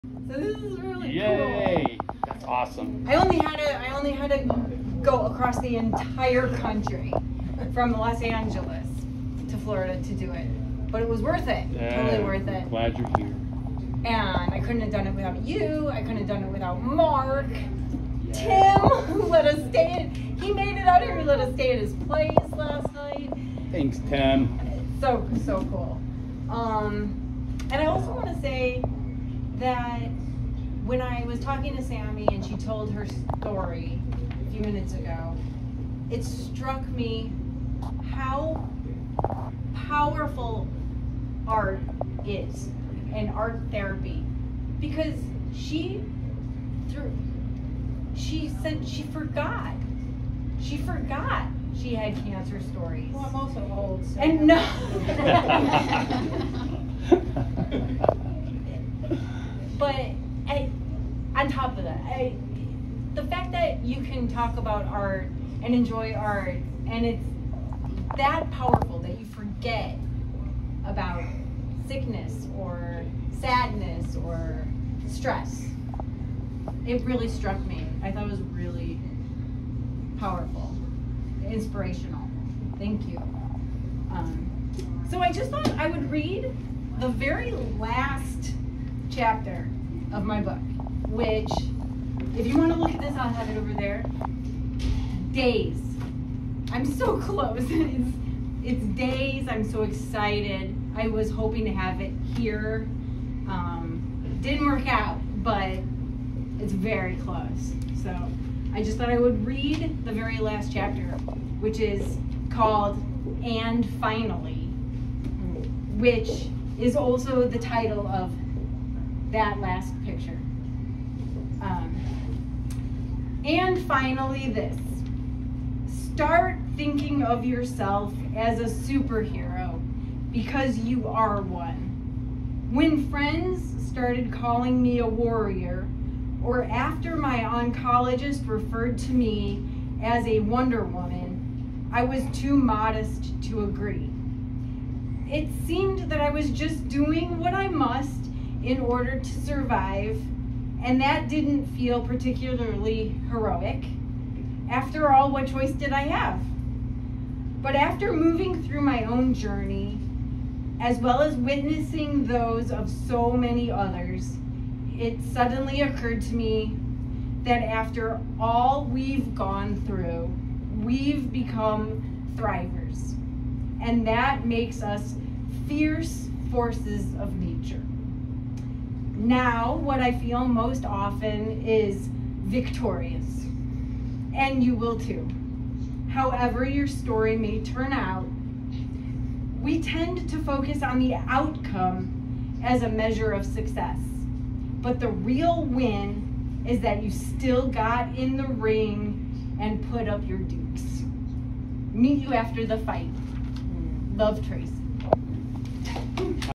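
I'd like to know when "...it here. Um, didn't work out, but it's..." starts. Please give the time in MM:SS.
01:41.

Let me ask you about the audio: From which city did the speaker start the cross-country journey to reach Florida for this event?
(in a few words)
Los Angeles.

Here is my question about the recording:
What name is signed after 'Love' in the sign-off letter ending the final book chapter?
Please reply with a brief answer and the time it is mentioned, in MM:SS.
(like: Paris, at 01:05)
Tracy, at 03:24.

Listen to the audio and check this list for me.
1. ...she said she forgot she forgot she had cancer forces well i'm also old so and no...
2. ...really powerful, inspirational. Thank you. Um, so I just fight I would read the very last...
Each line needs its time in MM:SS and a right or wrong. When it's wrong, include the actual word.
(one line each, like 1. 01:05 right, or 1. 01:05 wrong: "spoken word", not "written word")
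1. 00:48 wrong: "stories", not "forces"
2. 01:18 wrong: "thought", not "fight".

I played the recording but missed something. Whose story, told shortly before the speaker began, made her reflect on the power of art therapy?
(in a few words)
Sammy.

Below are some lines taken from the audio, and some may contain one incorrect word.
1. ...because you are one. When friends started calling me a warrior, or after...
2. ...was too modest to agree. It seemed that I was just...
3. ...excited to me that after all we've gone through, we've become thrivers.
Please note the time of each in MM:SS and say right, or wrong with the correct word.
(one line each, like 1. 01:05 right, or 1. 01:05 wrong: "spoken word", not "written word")
1. 02:10 right
2. 02:22 right
3. 02:45 wrong: "occurred", not "excited".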